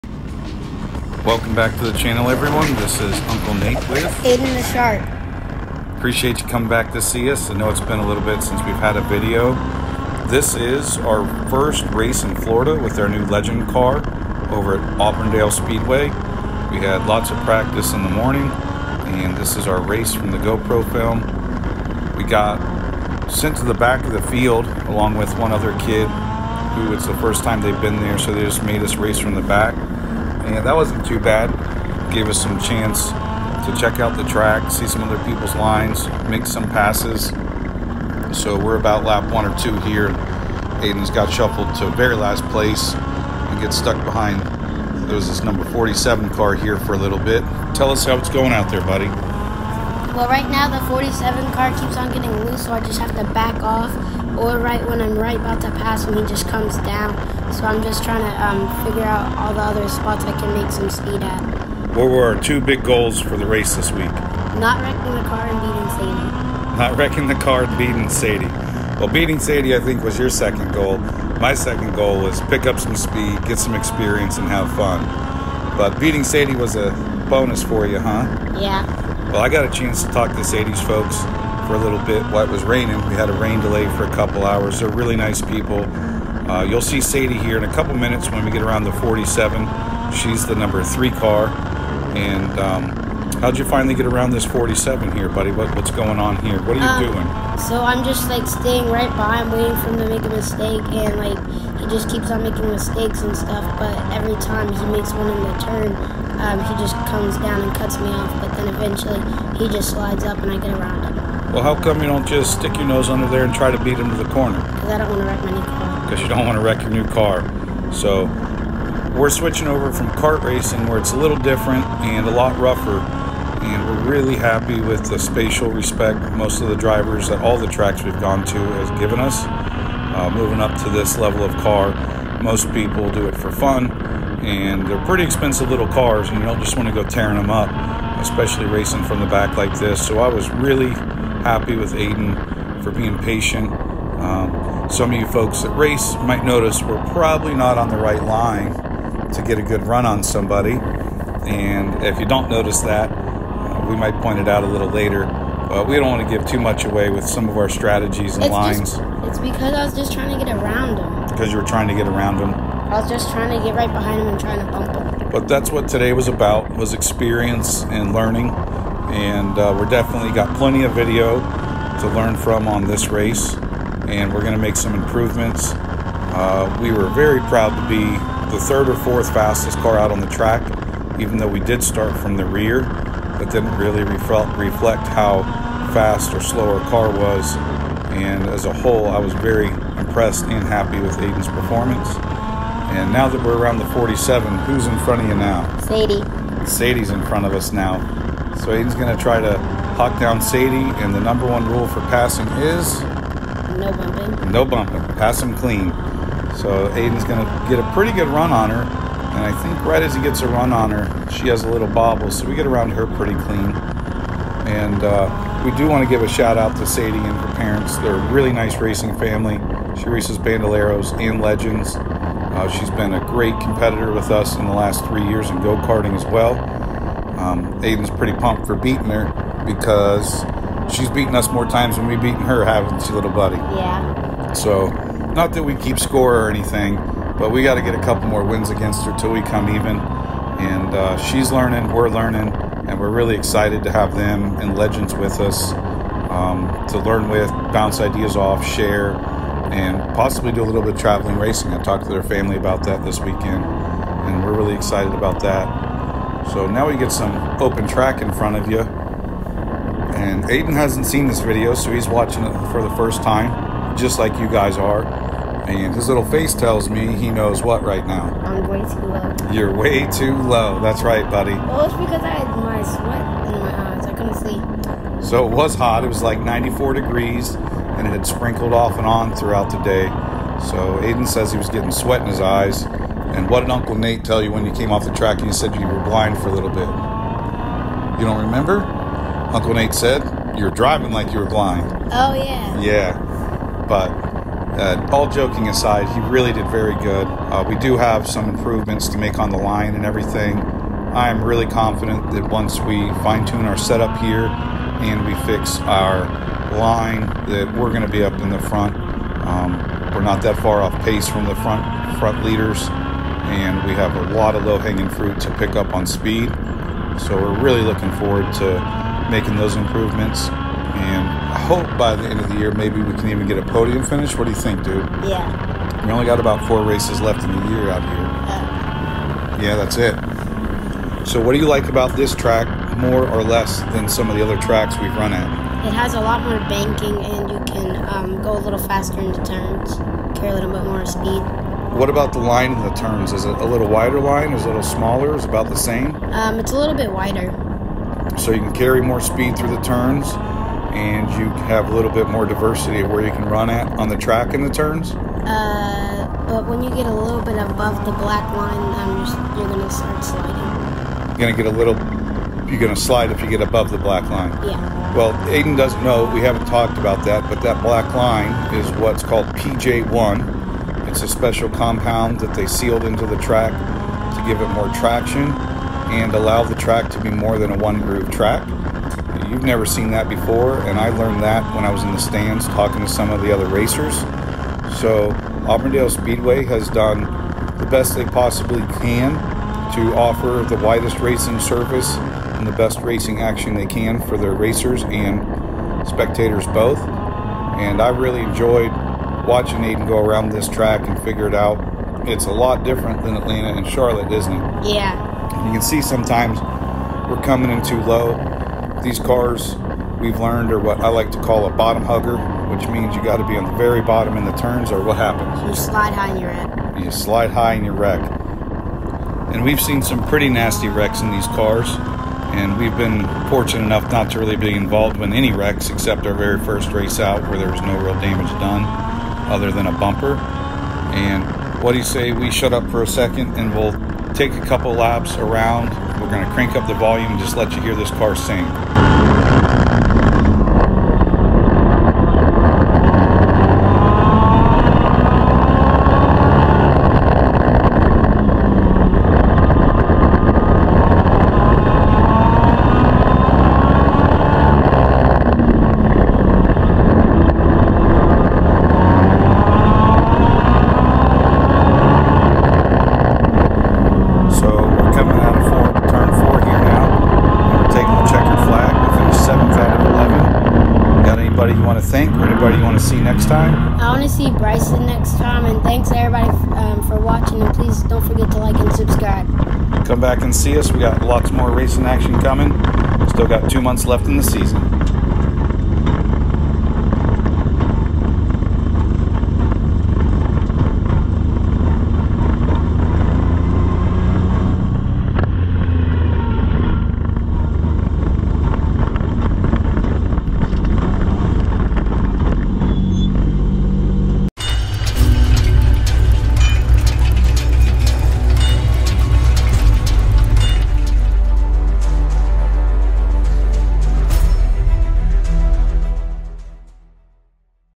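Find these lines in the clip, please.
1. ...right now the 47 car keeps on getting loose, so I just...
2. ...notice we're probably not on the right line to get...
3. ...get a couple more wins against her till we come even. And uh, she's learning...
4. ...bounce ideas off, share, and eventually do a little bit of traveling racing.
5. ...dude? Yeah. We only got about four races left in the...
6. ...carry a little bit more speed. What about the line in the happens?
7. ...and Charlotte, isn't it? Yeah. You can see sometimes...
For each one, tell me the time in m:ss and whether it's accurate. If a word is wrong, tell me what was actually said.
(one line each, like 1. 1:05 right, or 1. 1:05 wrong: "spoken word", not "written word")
1. 0:50 right
2. 2:26 right
3. 3:57 right
4. 4:07 wrong: "possibly", not "eventually"
5. 5:24 right
6. 5:40 wrong: "turns", not "happens"
7. 6:43 right.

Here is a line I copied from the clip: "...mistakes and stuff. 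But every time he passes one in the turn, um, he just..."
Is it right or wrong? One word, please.
wrong.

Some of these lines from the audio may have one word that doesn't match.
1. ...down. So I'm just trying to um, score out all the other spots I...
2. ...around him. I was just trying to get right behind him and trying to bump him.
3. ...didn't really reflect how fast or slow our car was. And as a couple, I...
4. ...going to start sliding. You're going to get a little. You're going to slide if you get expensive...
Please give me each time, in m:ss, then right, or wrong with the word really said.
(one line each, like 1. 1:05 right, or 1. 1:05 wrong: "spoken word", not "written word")
1. 0:56 wrong: "figure", not "score"
2. 2:42 right
3. 3:03 wrong: "whole", not "couple"
4. 5:59 wrong: "above", not "expensive".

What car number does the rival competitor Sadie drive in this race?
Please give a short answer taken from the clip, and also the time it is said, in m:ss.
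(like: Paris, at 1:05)
3, at 1:30.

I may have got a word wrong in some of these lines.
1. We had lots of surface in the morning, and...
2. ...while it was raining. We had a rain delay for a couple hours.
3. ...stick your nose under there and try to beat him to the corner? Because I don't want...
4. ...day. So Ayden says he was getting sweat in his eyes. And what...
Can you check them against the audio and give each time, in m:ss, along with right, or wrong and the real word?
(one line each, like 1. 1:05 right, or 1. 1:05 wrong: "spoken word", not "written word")
1. 0:16 wrong: "practice", not "surface"
2. 1:22 right
3. 1:52 right
4. 4:39 right.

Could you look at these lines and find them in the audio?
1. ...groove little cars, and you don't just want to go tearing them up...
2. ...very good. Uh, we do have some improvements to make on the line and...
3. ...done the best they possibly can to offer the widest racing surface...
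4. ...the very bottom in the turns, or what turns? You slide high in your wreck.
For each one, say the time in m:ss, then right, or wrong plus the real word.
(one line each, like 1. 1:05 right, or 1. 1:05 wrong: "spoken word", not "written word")
1. 2:15 wrong: "expensive", not "groove"
2. 4:56 right
3. 6:26 right
4. 6:53 wrong: "happens", not "turns".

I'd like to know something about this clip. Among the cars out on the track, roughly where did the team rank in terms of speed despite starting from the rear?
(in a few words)
third or fourth fastest.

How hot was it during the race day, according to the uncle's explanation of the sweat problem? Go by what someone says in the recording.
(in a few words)
94 degrees.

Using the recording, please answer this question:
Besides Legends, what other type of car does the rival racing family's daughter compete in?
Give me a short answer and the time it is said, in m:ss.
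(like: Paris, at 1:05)
Bandoleros, at 3:40.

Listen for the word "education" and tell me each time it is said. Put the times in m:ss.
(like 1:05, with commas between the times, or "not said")
not said.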